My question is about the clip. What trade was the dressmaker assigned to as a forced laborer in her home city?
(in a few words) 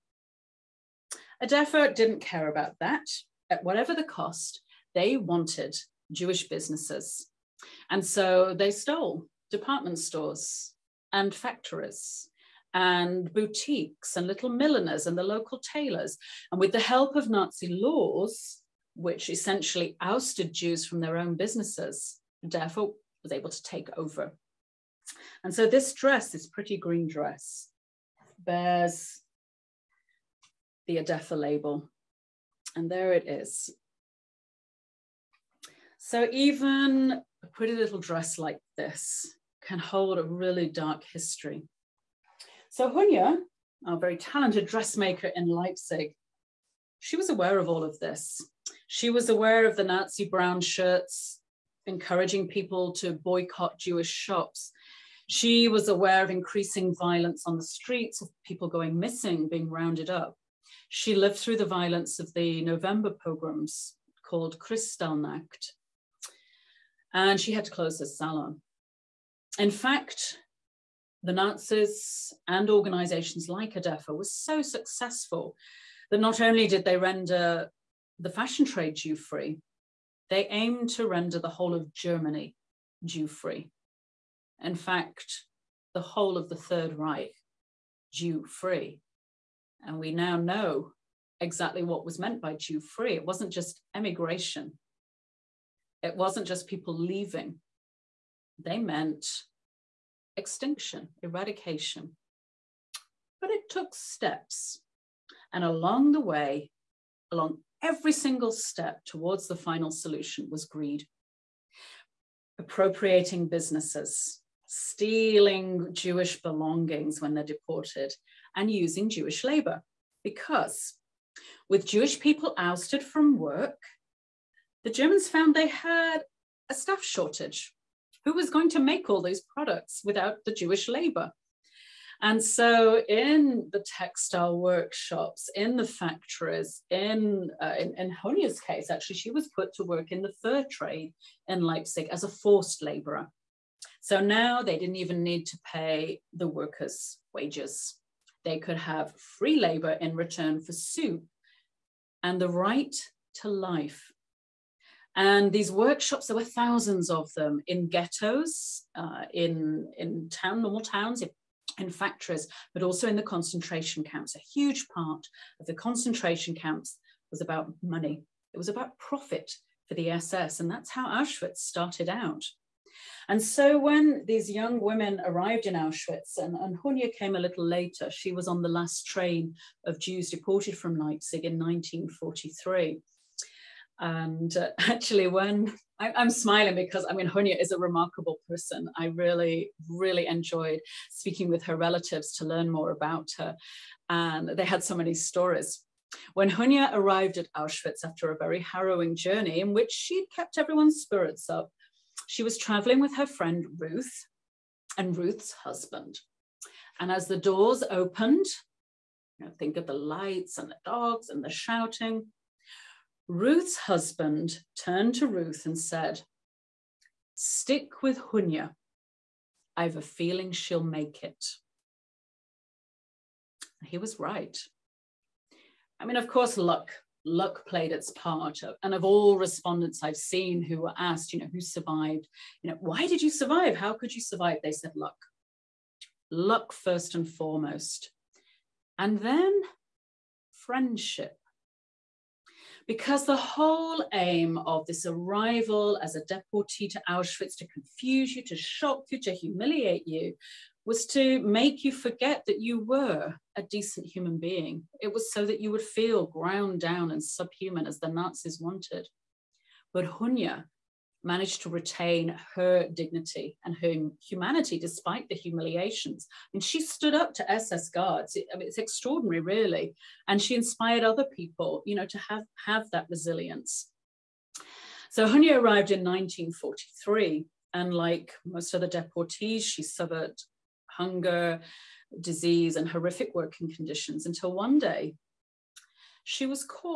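The fur trade.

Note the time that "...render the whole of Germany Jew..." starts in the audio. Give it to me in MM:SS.
01:21.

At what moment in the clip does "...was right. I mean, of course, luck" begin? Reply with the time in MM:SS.
03:43.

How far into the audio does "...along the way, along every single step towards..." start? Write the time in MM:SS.
01:45.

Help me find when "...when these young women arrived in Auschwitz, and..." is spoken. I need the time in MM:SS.
02:53.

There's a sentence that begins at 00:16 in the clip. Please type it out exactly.
And with the help of Nazi laws, which essentially ousted Jews from their own businesses, therefore was able to take over.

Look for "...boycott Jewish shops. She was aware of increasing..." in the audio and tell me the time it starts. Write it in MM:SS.
00:53.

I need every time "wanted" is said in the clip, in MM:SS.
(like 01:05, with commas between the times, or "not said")
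00:05, 04:18.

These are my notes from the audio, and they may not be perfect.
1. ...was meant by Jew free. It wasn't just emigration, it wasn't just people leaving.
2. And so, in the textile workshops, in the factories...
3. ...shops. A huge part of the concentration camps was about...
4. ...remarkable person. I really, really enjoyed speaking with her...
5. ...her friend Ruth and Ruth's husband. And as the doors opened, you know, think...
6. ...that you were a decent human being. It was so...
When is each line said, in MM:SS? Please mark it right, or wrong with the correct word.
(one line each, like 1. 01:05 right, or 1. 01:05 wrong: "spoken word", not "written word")
1. 01:32 right
2. 02:12 right
3. 02:44 wrong: "camps", not "shops"
4. 03:07 right
5. 03:23 right
6. 04:12 right.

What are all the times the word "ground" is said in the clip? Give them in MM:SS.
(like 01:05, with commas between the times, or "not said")
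04:16.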